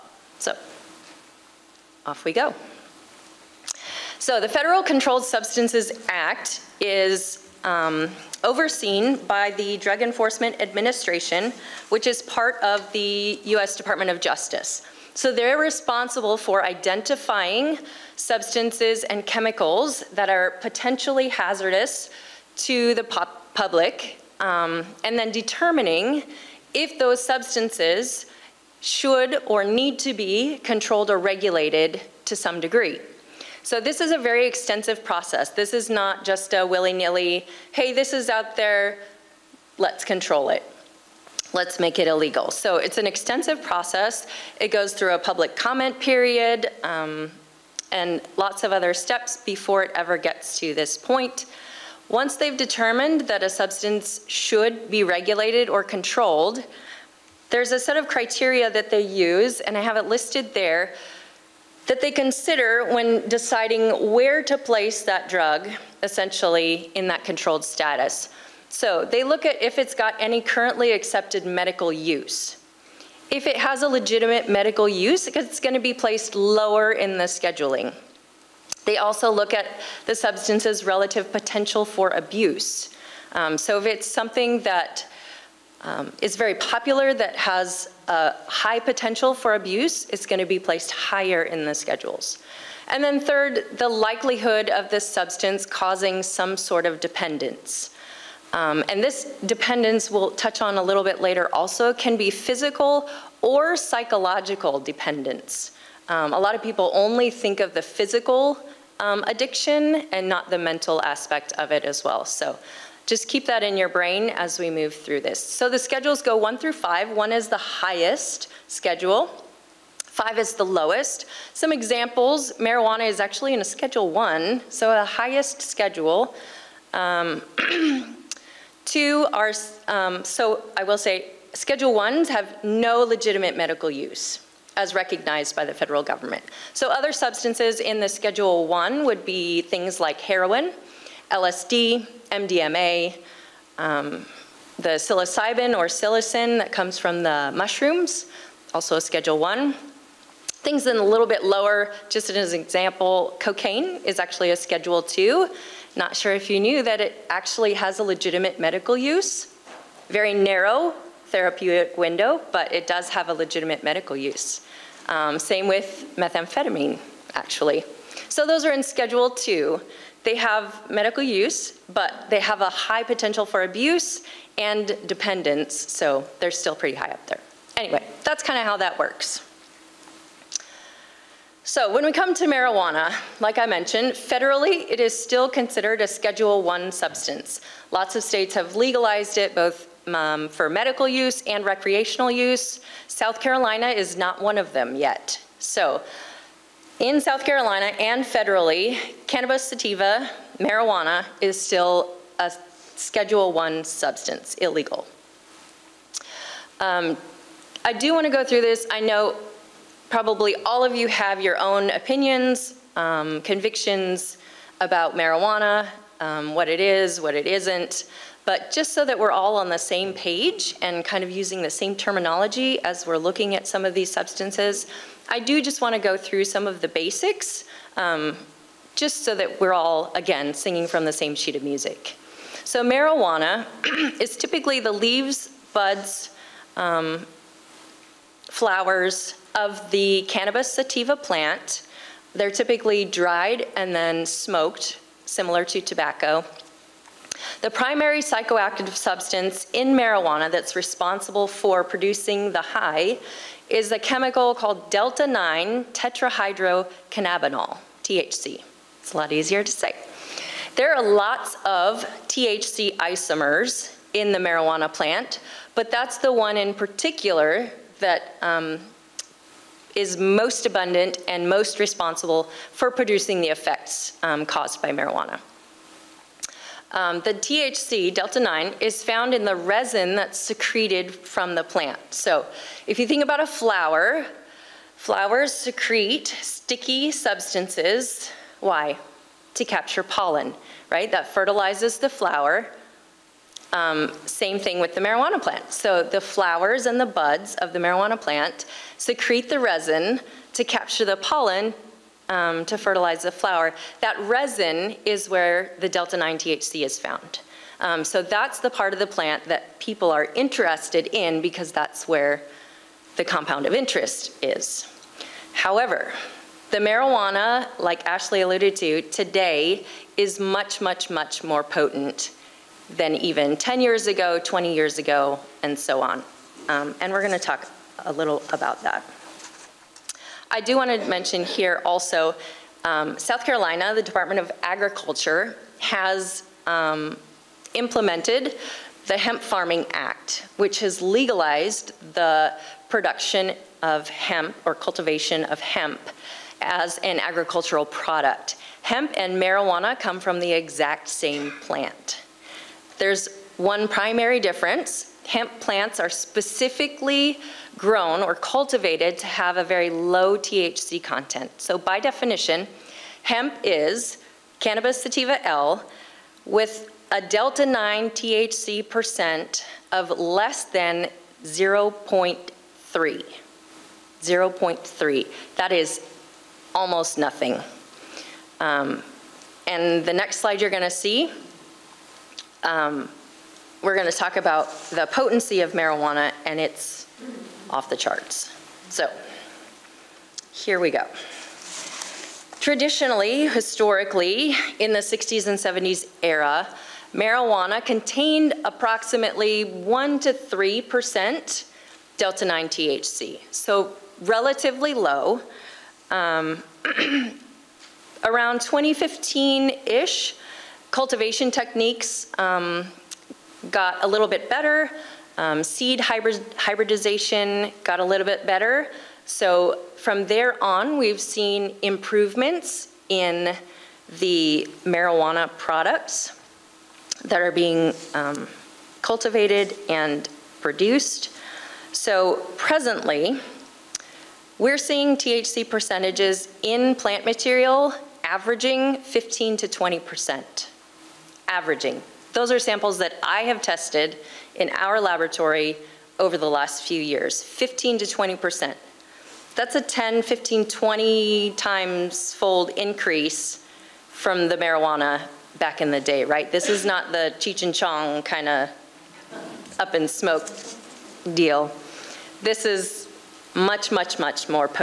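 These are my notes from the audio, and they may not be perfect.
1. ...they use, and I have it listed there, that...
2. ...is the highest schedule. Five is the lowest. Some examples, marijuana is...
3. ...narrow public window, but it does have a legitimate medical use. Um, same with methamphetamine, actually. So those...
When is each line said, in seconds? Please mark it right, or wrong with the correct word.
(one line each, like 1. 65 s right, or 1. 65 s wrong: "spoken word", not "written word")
1. 58 s right
2. 117 s right
3. 160 s wrong: "therapeutic", not "public".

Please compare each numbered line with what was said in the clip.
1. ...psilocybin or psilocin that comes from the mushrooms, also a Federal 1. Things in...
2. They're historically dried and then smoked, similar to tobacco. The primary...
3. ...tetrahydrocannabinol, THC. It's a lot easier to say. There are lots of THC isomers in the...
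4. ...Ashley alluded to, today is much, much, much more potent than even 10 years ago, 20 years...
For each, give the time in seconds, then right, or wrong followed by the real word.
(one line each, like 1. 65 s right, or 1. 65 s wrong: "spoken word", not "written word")
1. 144 s wrong: "Schedule", not "Federal"
2. 242 s wrong: "typically", not "historically"
3. 255 s right
4. 318 s right.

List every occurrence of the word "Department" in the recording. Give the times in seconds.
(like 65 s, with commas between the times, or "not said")
13 s, 334 s.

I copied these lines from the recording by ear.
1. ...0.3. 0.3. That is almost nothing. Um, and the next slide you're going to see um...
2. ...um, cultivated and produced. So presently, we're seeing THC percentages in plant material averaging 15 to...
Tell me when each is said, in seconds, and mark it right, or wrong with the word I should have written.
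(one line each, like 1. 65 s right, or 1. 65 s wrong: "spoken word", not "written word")
1. 371 s right
2. 428 s right.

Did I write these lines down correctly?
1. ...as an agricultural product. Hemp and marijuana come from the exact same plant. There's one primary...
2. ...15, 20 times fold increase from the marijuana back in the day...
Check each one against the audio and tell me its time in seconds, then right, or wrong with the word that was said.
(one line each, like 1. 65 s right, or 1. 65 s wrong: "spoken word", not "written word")
1. 346 s right
2. 450 s right.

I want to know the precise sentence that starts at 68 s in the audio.
So they look at if it's got any currently accepted medical use.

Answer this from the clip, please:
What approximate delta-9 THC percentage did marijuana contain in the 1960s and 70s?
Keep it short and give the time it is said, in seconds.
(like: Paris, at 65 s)
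1 to 3%, at 399 s.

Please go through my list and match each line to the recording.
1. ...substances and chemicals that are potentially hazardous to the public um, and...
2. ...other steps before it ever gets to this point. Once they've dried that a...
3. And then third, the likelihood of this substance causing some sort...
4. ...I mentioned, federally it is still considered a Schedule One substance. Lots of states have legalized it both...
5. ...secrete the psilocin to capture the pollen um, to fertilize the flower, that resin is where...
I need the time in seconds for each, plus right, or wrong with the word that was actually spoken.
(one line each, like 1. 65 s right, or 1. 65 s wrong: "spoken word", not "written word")
1. 18 s right
2. 48 s wrong: "determined", not "dried"
3. 92 s right
4. 183 s right
5. 298 s wrong: "resin", not "psilocin".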